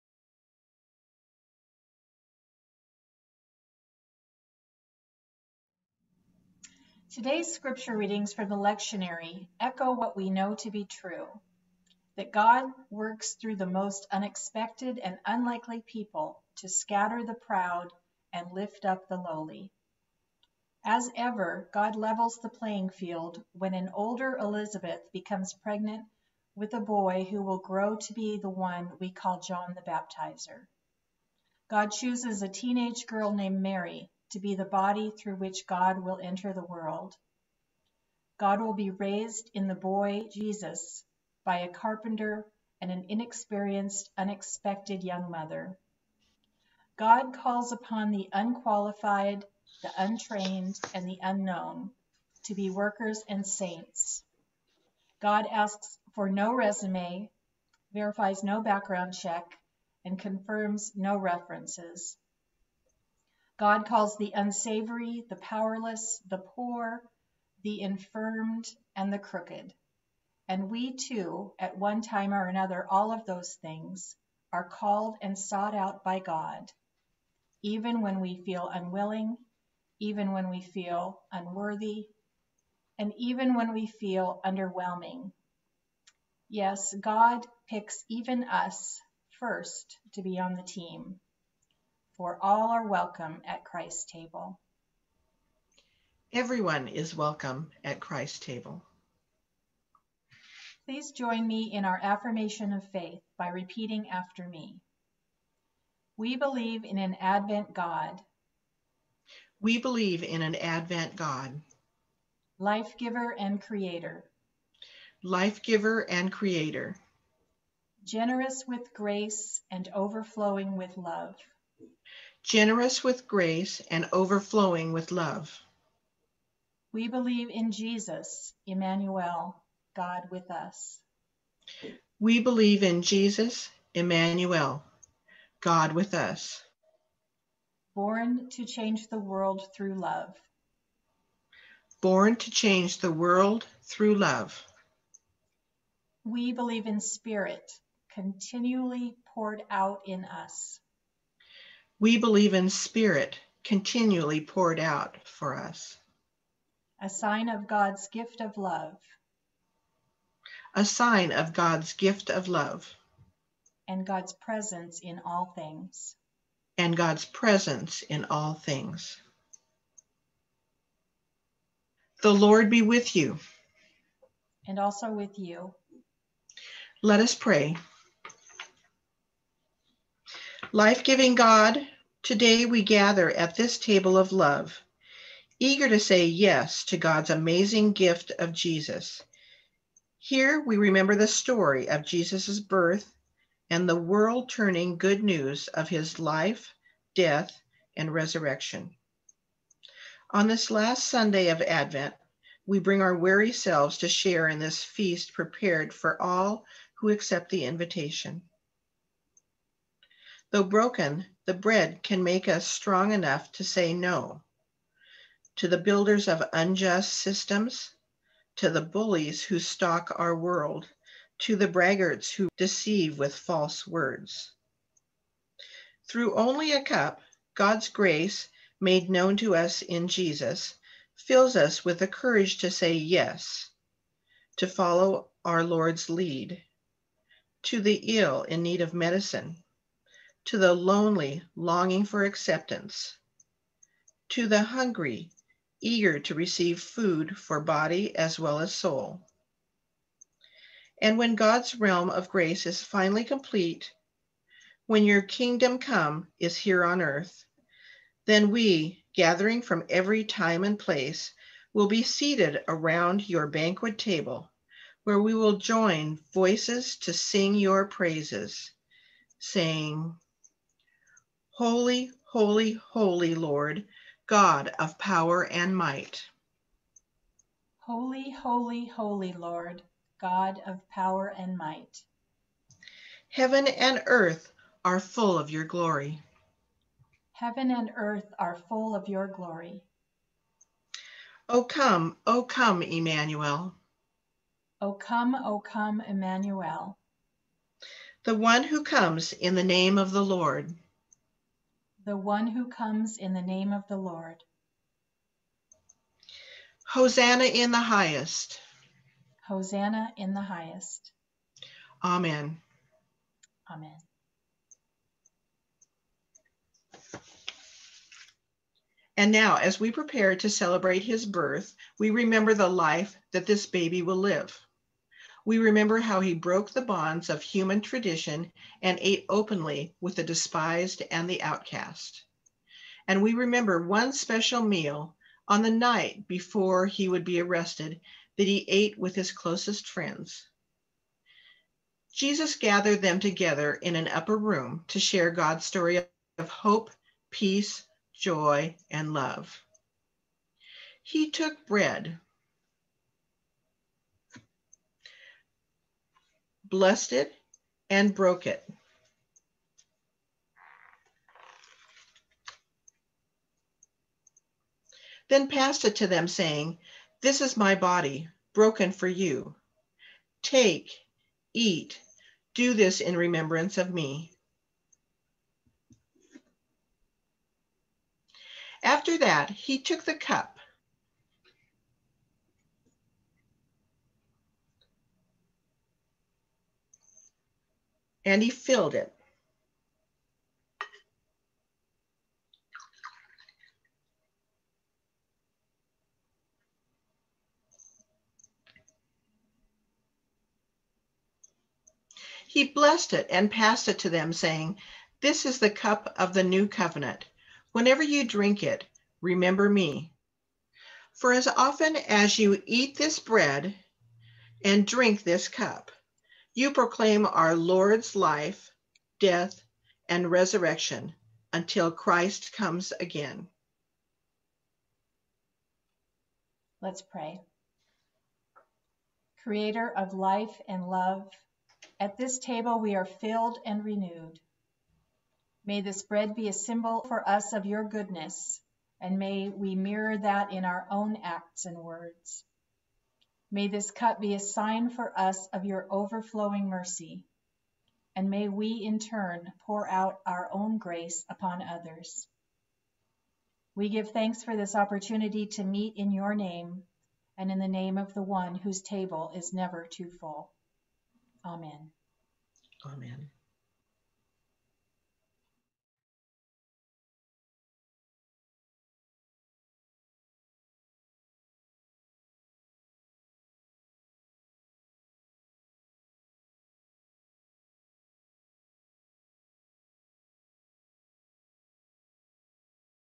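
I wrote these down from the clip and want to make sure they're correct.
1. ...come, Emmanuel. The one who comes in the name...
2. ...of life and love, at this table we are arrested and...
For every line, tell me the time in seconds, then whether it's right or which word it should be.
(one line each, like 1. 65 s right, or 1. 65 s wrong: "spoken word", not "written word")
1. 295 s right
2. 429 s wrong: "filled", not "arrested".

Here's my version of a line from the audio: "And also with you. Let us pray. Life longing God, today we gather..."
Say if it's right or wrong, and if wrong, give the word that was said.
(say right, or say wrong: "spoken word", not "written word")
wrong: "giving", not "longing".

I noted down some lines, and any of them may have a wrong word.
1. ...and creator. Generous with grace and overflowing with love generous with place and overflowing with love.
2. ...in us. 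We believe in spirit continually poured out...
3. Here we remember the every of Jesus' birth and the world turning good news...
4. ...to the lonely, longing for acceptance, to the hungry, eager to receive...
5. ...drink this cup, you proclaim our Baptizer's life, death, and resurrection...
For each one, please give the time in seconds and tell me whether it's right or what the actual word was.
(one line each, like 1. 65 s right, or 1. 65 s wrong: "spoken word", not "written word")
1. 116 s wrong: "grace", not "place"
2. 150 s right
3. 190 s wrong: "story", not "every"
4. 240 s right
5. 414 s wrong: "Lord", not "Baptizer".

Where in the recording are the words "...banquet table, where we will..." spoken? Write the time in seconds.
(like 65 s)
263 s.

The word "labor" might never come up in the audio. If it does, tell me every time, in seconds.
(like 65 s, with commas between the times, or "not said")
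not said.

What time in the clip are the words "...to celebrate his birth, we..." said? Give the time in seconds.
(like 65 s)
320 s.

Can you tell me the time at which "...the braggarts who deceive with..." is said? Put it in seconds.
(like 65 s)
221 s.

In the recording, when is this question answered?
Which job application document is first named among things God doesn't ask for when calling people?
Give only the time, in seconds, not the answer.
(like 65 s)
56 s.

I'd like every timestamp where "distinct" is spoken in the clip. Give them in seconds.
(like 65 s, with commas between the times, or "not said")
not said.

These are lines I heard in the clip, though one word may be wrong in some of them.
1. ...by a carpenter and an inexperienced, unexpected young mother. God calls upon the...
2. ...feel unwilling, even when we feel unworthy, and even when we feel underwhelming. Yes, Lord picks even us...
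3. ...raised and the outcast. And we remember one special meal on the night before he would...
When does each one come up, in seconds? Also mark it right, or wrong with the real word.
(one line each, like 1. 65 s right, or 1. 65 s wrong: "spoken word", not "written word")
1. 41 s right
2. 78 s wrong: "God", not "Lord"
3. 330 s wrong: "despised", not "raised".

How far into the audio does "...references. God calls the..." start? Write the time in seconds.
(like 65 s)
61 s.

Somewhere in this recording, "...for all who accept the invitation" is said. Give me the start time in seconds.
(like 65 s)
205 s.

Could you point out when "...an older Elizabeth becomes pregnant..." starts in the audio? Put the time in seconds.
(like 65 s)
23 s.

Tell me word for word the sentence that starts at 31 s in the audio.
God chooses a teenage girl named Mary to be the body through which God will enter the world.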